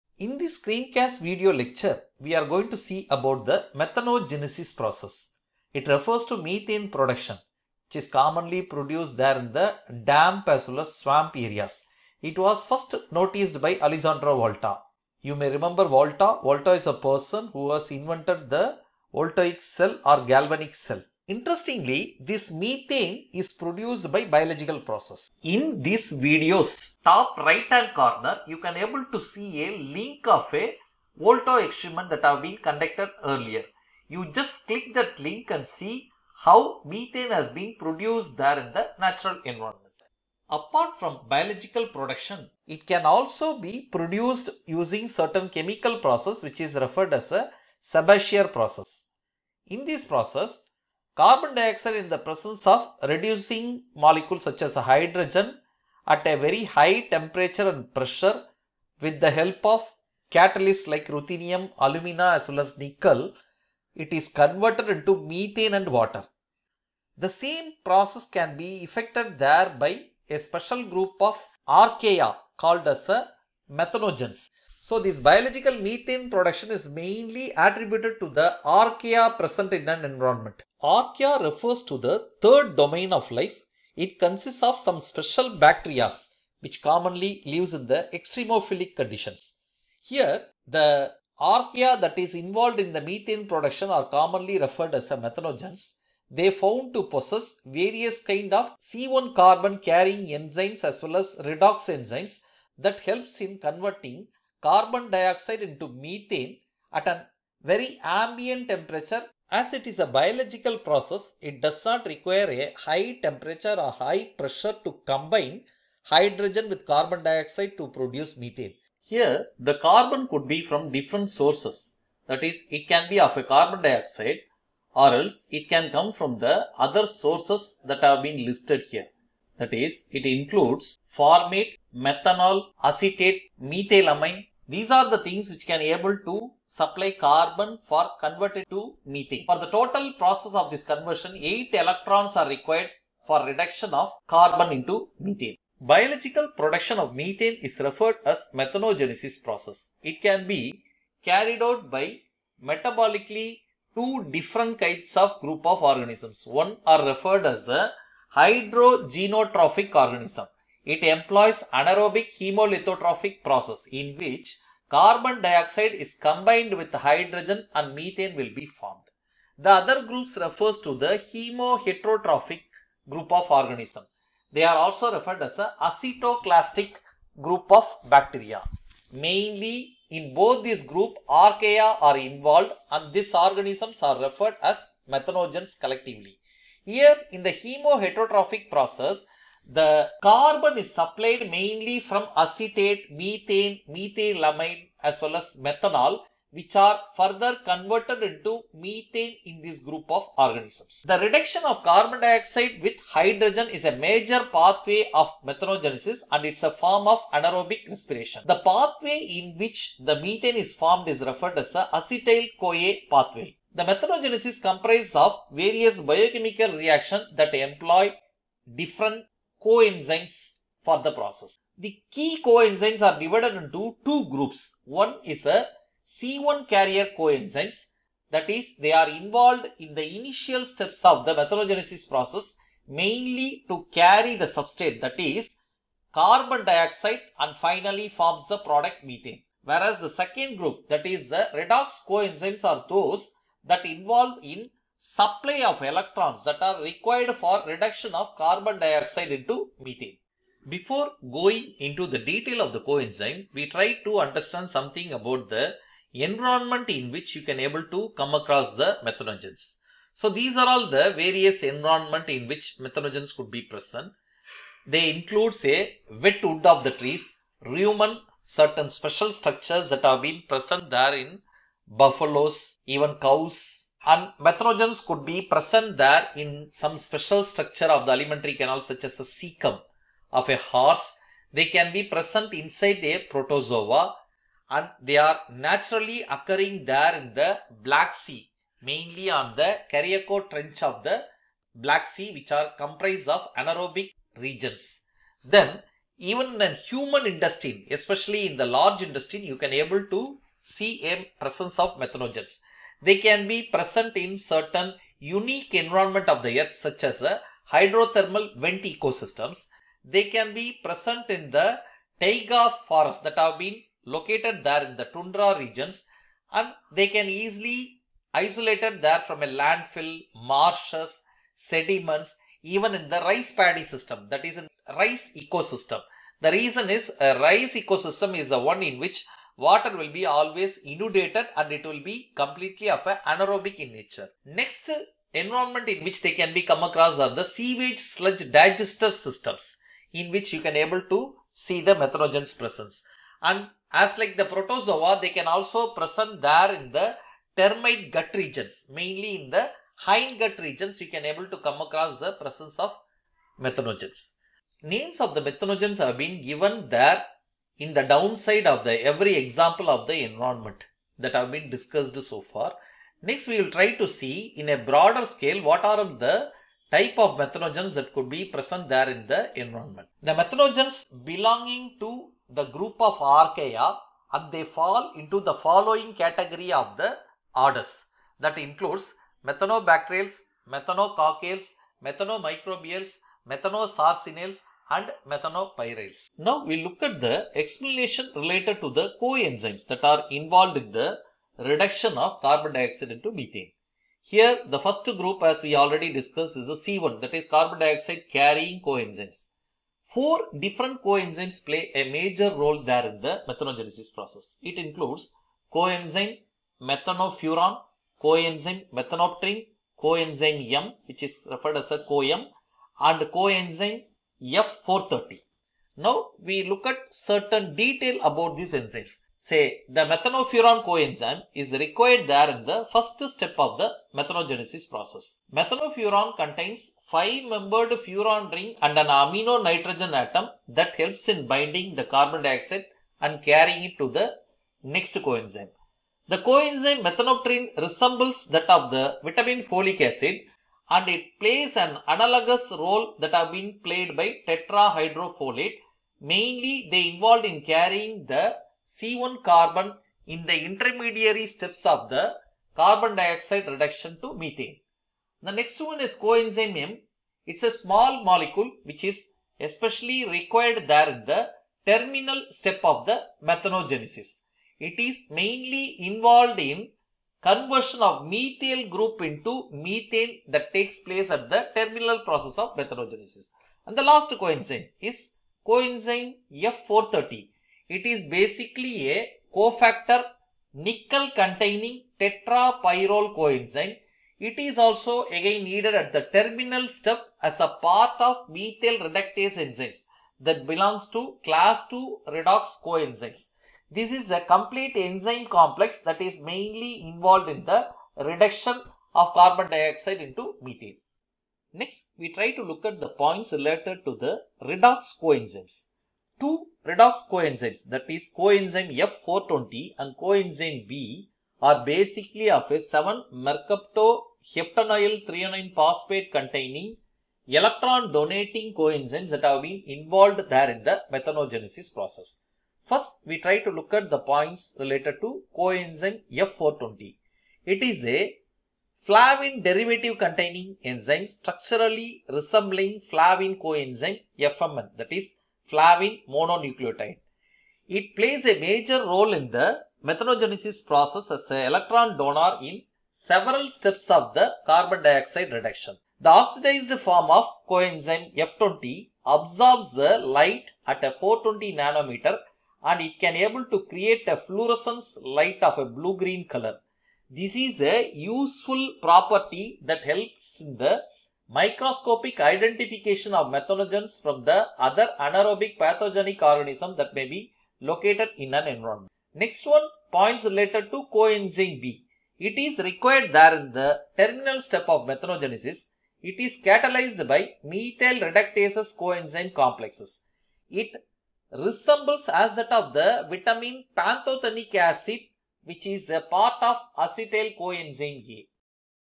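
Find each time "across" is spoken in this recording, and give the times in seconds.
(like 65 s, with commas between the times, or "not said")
258 s, 336 s, 351 s.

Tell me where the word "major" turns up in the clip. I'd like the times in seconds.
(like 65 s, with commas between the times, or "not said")
203 s, 402 s, 538 s.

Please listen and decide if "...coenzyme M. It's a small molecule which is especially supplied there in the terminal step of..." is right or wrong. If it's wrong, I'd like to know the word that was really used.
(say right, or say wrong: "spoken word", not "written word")
wrong: "required", not "supplied".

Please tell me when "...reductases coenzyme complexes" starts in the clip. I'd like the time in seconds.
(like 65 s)
578 s.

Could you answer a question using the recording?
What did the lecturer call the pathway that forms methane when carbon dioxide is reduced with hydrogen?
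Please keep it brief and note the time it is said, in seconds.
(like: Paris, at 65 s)
acetyl-CoA pathway, at 211 s.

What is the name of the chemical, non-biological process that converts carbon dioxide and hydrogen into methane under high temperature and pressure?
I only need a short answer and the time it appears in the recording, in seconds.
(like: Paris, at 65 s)
Sabatier process, at 47 s.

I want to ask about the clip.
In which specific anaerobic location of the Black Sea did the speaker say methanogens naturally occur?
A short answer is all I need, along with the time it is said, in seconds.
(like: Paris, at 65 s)
Cariaco Trench, at 289 s.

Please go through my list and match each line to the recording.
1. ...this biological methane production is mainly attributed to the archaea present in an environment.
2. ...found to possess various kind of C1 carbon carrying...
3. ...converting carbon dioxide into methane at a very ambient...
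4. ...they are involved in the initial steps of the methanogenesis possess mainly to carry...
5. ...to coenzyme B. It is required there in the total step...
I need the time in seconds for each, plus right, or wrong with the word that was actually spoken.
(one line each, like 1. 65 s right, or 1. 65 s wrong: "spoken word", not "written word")
1. 74 s right
2. 96 s right
3. 103 s right
4. 228 s wrong: "process", not "possess"
5. 570 s wrong: "terminal", not "total".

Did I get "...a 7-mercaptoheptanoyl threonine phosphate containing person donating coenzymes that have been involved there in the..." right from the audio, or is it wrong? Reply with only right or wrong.
wrong.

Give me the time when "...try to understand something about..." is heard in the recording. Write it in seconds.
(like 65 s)
253 s.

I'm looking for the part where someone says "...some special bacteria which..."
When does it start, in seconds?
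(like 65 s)
84 s.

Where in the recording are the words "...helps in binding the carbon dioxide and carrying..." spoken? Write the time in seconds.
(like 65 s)
430 s.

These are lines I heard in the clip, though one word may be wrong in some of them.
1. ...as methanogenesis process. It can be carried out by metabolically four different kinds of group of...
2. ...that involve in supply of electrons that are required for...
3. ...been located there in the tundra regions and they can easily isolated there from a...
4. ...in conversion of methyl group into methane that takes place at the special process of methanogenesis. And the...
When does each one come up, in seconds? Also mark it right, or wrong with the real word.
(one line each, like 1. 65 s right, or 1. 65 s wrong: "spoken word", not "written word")
1. 148 s wrong: "two", not "four"
2. 243 s right
3. 313 s right
4. 466 s wrong: "terminal", not "special".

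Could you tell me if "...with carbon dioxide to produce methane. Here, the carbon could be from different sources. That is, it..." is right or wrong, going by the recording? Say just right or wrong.
right.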